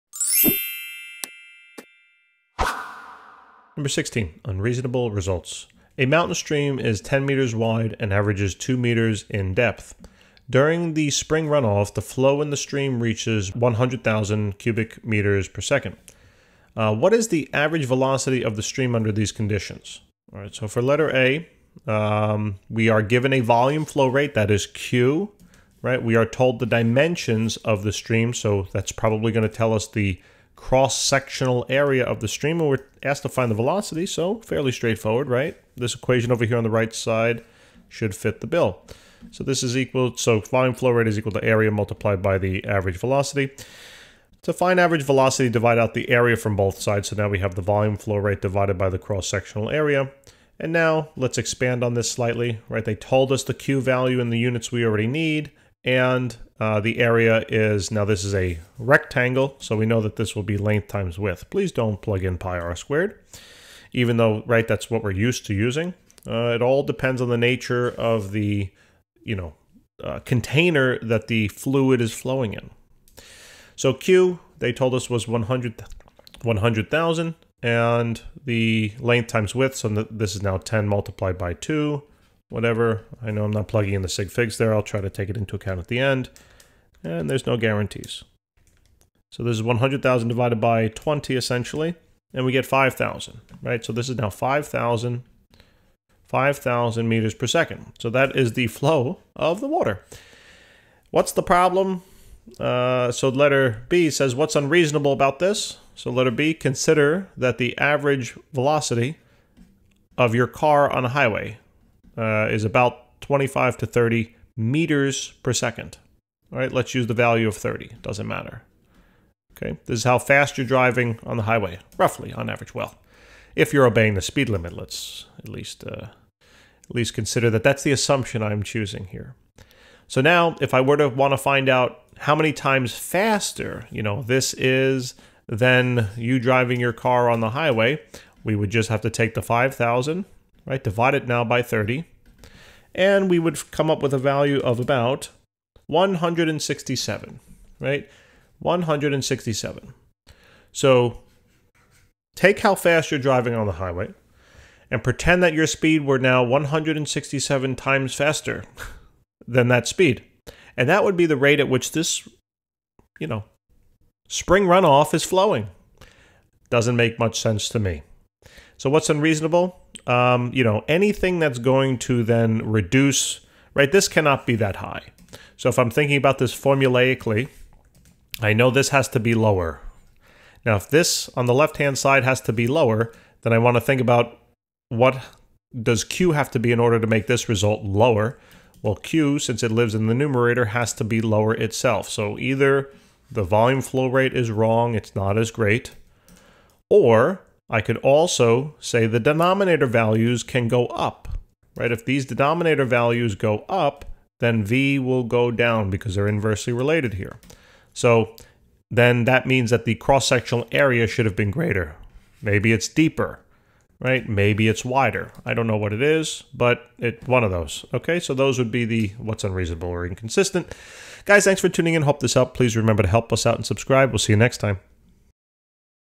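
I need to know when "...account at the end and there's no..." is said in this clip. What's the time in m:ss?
1:25.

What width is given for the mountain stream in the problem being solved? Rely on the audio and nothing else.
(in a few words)
10 meters.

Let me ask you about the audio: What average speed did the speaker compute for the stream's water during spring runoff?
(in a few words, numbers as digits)
5,000 meters per second.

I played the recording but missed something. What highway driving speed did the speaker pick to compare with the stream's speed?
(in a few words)
30.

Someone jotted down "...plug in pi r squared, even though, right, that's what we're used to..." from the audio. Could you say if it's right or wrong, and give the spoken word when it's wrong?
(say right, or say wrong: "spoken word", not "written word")
right.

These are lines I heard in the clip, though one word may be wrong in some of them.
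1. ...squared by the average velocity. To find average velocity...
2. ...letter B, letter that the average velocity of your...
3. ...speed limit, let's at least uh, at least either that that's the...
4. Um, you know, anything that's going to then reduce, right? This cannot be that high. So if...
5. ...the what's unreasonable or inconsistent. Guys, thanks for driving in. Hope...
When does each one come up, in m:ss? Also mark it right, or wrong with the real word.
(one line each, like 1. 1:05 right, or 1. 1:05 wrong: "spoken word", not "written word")
1. 0:41 wrong: "multiplied", not "squared"
2. 1:46 wrong: "consider", not "letter"
3. 2:04 wrong: "consider", not "either"
4. 2:50 right
5. 3:38 wrong: "tuning", not "driving".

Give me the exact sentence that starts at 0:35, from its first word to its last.
This equation over here on the right side should fit the bill.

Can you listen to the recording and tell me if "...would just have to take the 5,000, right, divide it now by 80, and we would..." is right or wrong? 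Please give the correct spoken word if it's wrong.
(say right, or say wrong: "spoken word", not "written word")
wrong: "30", not "80".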